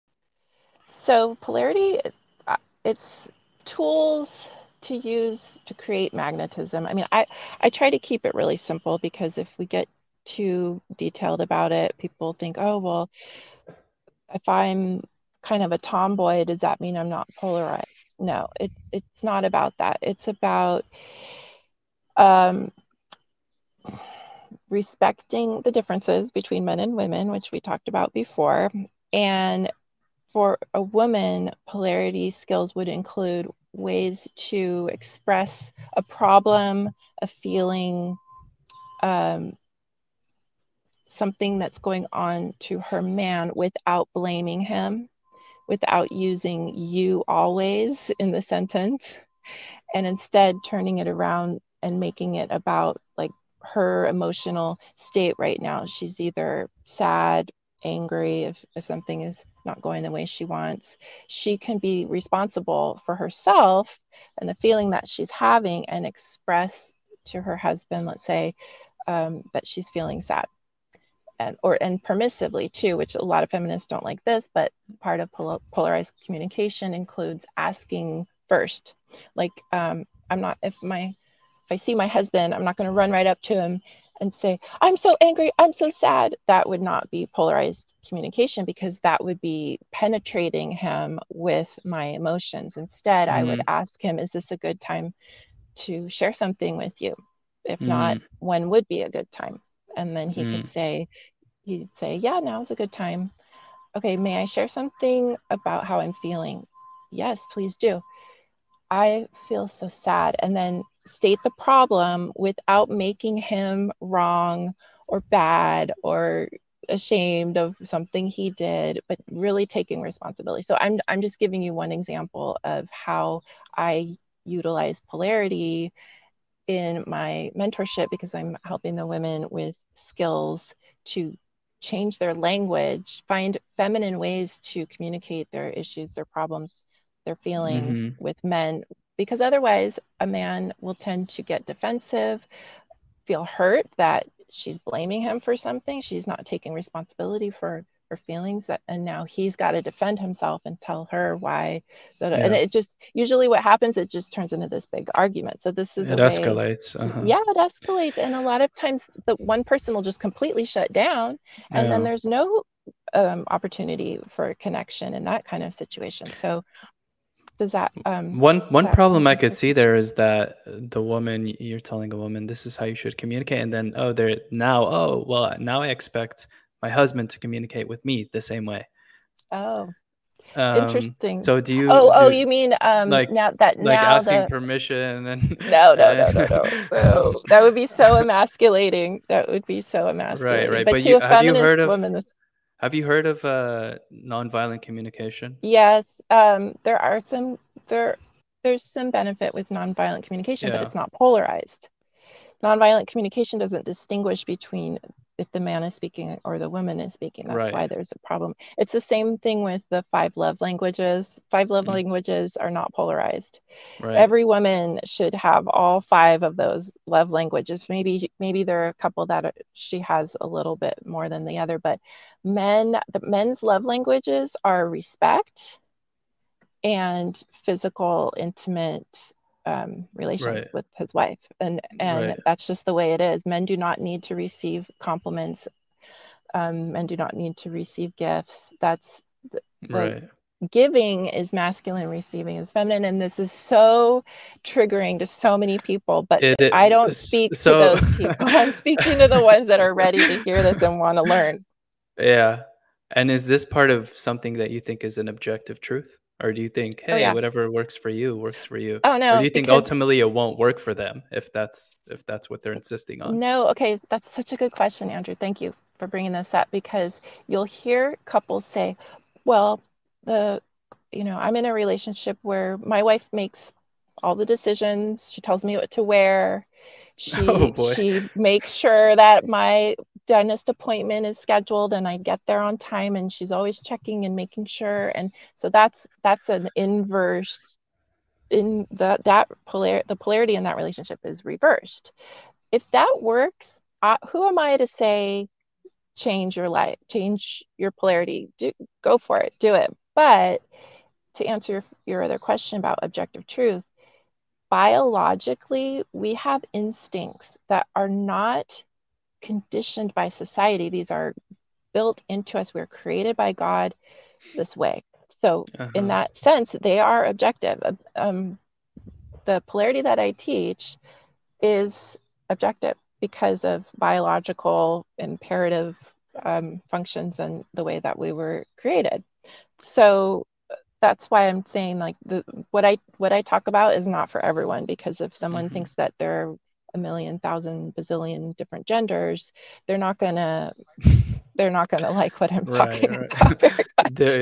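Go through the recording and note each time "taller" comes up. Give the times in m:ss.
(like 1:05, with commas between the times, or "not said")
not said.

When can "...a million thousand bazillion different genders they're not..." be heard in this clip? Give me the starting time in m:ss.
5:36.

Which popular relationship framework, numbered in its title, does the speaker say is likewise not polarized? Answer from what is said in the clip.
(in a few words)
Five love languages.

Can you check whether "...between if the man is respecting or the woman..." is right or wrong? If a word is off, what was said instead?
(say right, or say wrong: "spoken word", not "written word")
wrong: "speaking", not "respecting".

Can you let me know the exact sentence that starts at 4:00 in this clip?
giving is masculine receiving is feminine and this is so triggering to so many people but it, it, i don't speak so...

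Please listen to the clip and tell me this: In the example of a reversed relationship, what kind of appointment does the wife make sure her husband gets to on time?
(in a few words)
Dentist appointment.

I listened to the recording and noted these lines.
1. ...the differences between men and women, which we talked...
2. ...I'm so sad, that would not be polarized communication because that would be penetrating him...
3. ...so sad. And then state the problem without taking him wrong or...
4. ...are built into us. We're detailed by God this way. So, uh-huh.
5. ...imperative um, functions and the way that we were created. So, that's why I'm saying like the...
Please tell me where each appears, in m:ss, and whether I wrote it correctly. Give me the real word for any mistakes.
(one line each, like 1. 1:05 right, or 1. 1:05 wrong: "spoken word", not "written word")
1. 0:25 right
2. 1:25 right
3. 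1:49 wrong: "making", not "taking"
4. 5:11 wrong: "created", not "detailed"
5. 5:25 right.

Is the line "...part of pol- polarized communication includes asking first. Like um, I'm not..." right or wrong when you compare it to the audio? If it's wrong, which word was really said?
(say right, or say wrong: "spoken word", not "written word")
right.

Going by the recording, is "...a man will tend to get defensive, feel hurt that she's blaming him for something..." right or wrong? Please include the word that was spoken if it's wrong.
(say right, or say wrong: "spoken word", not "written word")
right.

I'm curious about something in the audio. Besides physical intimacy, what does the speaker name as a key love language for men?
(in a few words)
Respect.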